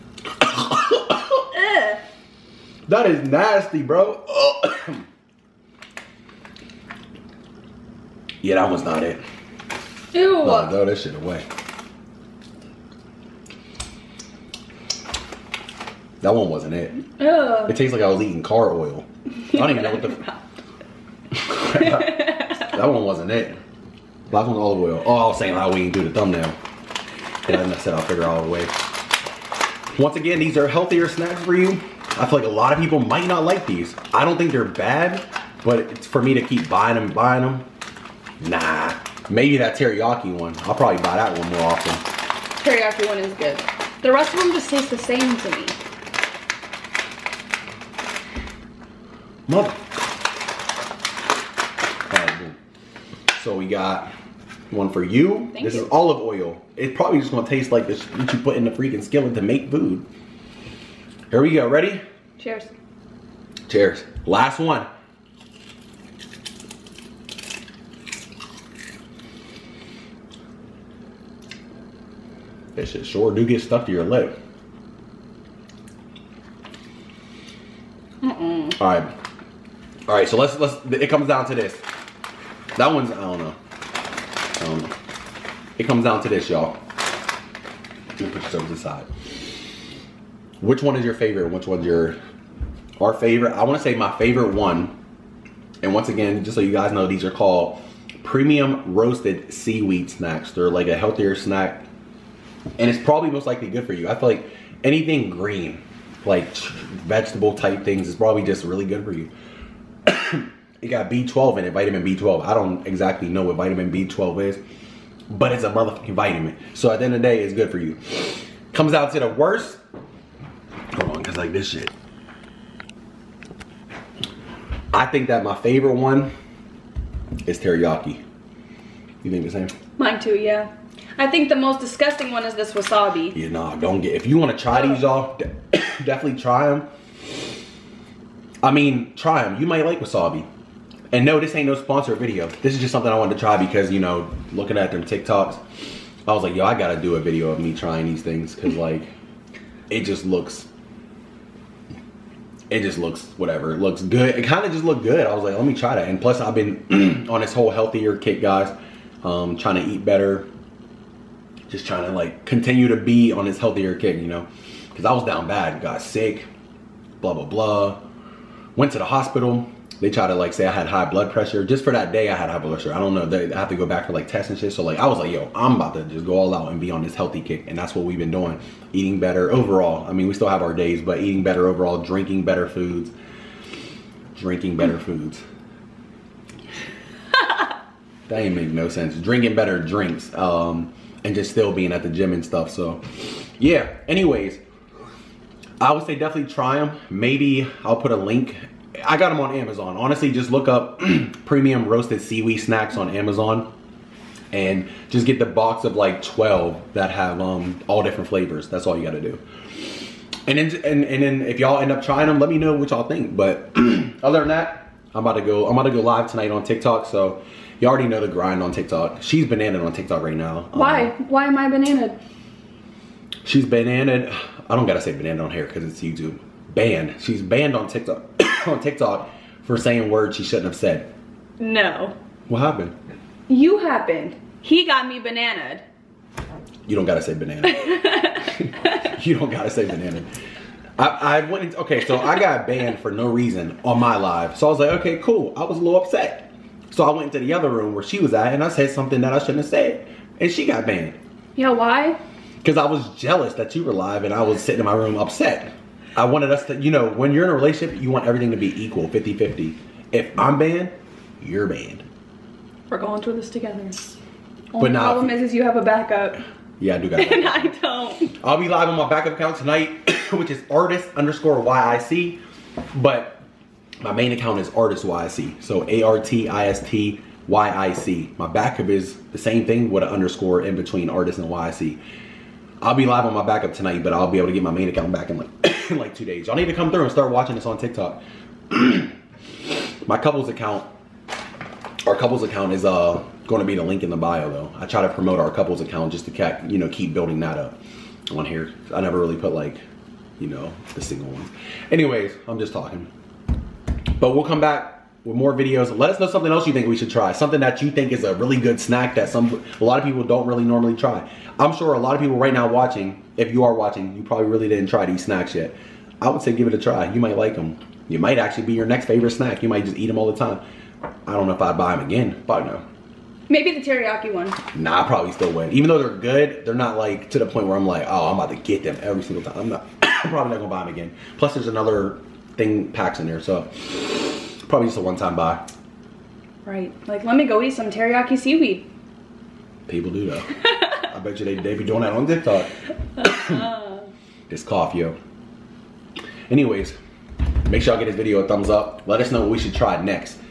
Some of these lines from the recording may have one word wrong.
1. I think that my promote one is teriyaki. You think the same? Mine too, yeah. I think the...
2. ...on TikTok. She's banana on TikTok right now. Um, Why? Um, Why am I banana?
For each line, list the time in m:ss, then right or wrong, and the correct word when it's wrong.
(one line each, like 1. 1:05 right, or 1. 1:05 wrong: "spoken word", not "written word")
1. 2:04 wrong: "favorite", not "promote"
2. 3:38 right.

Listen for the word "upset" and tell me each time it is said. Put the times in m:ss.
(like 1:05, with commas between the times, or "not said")
4:06, 4:15.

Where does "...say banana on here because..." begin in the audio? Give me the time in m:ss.
3:45.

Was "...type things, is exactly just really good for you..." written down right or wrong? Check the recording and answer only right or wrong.
wrong.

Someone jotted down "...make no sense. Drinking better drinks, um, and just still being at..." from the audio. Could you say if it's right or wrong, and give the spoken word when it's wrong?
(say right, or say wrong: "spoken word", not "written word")
right.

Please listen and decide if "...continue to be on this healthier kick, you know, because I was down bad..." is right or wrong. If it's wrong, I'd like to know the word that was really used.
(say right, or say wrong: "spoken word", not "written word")
right.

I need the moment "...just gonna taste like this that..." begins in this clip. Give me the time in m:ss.
0:57.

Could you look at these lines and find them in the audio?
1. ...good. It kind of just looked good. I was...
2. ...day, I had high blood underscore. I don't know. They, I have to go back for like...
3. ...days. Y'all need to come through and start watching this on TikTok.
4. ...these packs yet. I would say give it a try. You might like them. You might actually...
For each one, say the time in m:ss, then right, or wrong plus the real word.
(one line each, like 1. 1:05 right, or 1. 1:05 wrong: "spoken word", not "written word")
1. 2:34 right
2. 2:52 wrong: "pressure", not "underscore"
3. 4:46 right
4. 5:15 wrong: "snacks", not "packs".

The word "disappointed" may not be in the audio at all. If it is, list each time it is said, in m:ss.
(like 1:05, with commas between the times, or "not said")
not said.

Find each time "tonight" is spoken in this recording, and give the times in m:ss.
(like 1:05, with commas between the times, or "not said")
3:36, 4:29, 4:43.